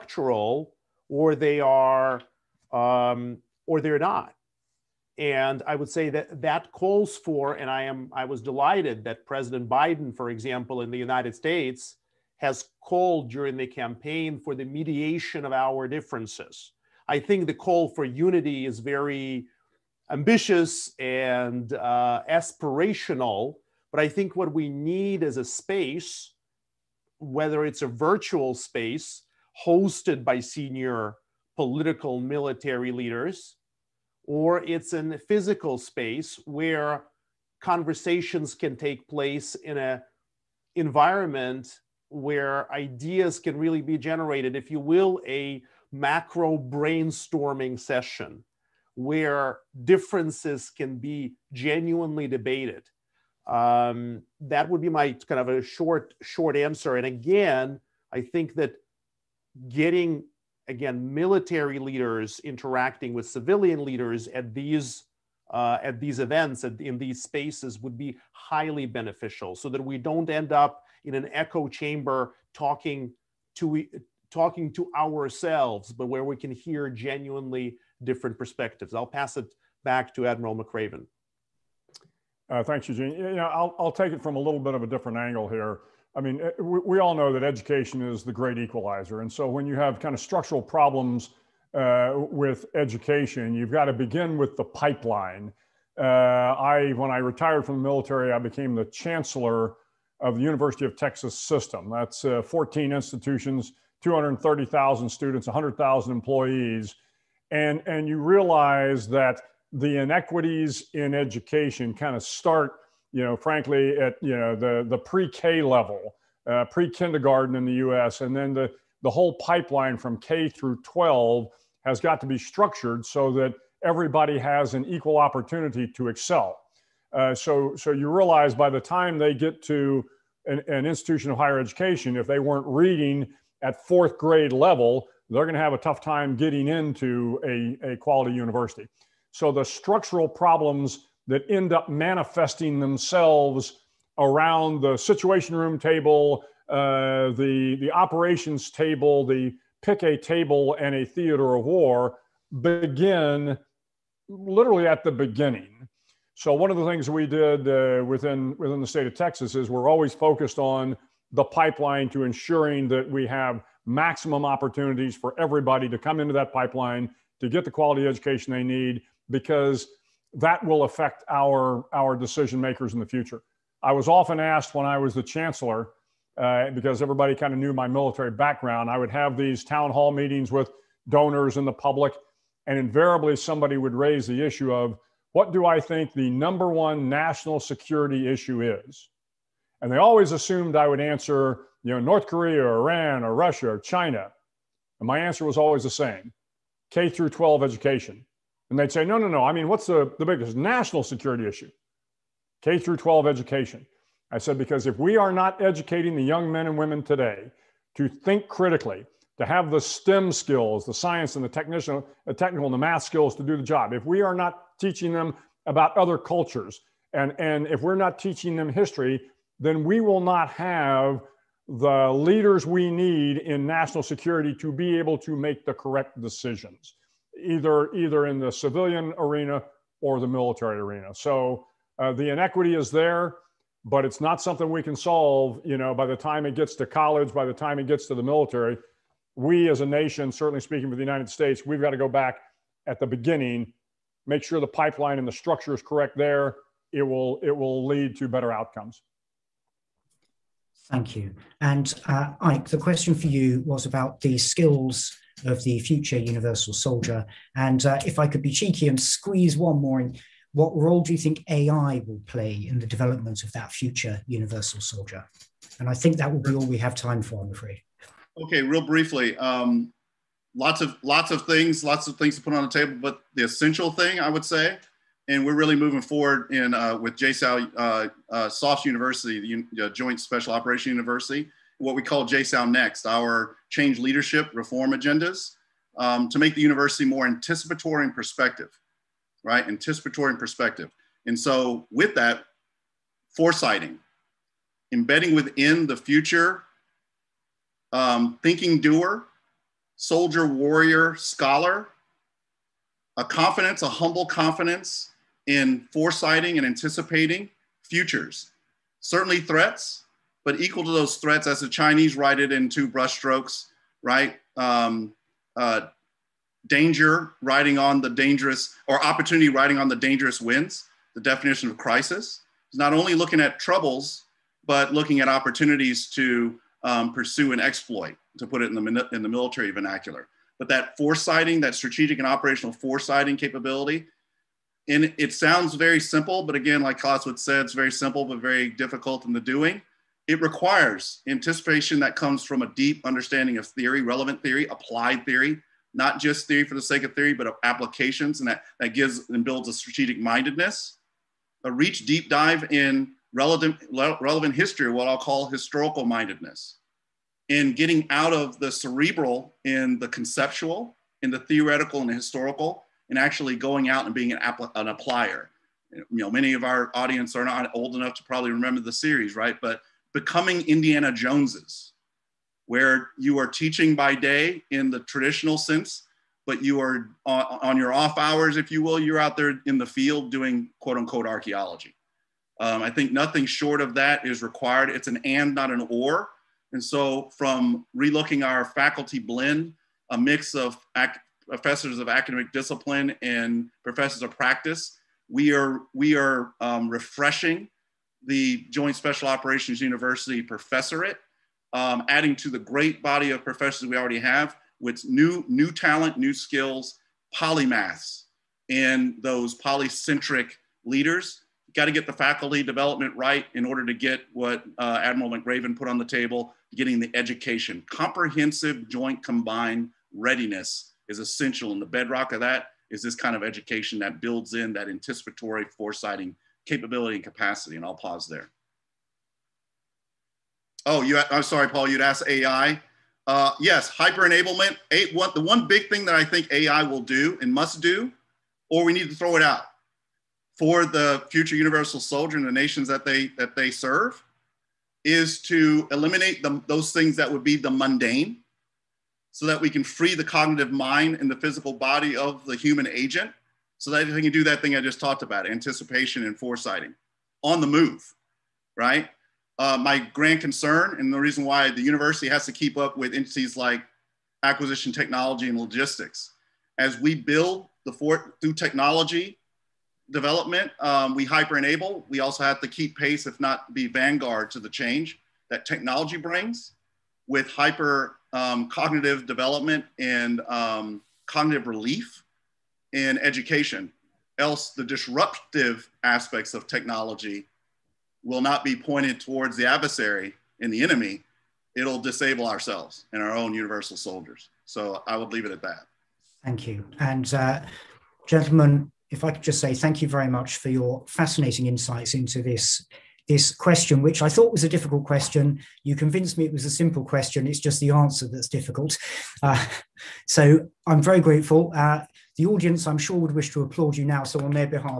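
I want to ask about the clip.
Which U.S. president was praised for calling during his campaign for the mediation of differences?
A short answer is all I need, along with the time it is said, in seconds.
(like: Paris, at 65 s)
Biden, at 9 s.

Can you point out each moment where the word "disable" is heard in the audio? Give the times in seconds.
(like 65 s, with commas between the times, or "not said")
491 s.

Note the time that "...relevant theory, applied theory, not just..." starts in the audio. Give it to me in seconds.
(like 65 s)
344 s.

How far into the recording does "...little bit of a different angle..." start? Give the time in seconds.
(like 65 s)
84 s.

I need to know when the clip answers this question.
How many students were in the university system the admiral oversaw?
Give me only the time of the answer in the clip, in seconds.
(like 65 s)
104 s.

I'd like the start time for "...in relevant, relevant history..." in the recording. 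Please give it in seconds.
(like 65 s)
352 s.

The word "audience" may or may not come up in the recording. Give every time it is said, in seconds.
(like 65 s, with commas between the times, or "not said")
366 s, 512 s.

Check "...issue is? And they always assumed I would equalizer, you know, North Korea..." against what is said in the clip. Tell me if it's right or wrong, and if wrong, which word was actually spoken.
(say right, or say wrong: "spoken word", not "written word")
wrong: "answer", not "equalizer".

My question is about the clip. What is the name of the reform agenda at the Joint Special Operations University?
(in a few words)
JSOU Next.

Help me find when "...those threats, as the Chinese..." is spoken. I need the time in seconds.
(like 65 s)
310 s.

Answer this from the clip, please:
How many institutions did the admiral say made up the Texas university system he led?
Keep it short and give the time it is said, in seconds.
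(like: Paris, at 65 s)
14, at 102 s.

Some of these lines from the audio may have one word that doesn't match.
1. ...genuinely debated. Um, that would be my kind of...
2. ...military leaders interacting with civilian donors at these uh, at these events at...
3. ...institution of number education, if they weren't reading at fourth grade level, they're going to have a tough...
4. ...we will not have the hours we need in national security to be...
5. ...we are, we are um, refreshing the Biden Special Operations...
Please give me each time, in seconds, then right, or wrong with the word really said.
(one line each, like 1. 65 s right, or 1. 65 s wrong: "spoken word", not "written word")
1. 51 s right
2. 61 s wrong: "leaders", not "donors"
3. 130 s wrong: "higher", not "number"
4. 219 s wrong: "leaders", not "hours"
5. 395 s wrong: "Joint", not "Biden".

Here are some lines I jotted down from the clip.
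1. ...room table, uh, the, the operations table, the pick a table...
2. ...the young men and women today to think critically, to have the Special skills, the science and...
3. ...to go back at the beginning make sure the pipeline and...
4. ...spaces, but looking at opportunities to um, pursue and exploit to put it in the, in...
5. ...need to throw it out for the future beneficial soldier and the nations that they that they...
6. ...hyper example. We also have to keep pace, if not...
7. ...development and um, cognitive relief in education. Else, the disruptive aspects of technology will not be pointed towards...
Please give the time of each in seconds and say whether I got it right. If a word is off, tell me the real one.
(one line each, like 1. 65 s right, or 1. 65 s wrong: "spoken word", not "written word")
1. 145 s right
2. 206 s wrong: "STEM", not "Special"
3. 241 s right
4. 323 s wrong: "troubles", not "spaces"
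5. 438 s wrong: "universal", not "beneficial"
6. 471 s wrong: "enable", not "example"
7. 479 s right.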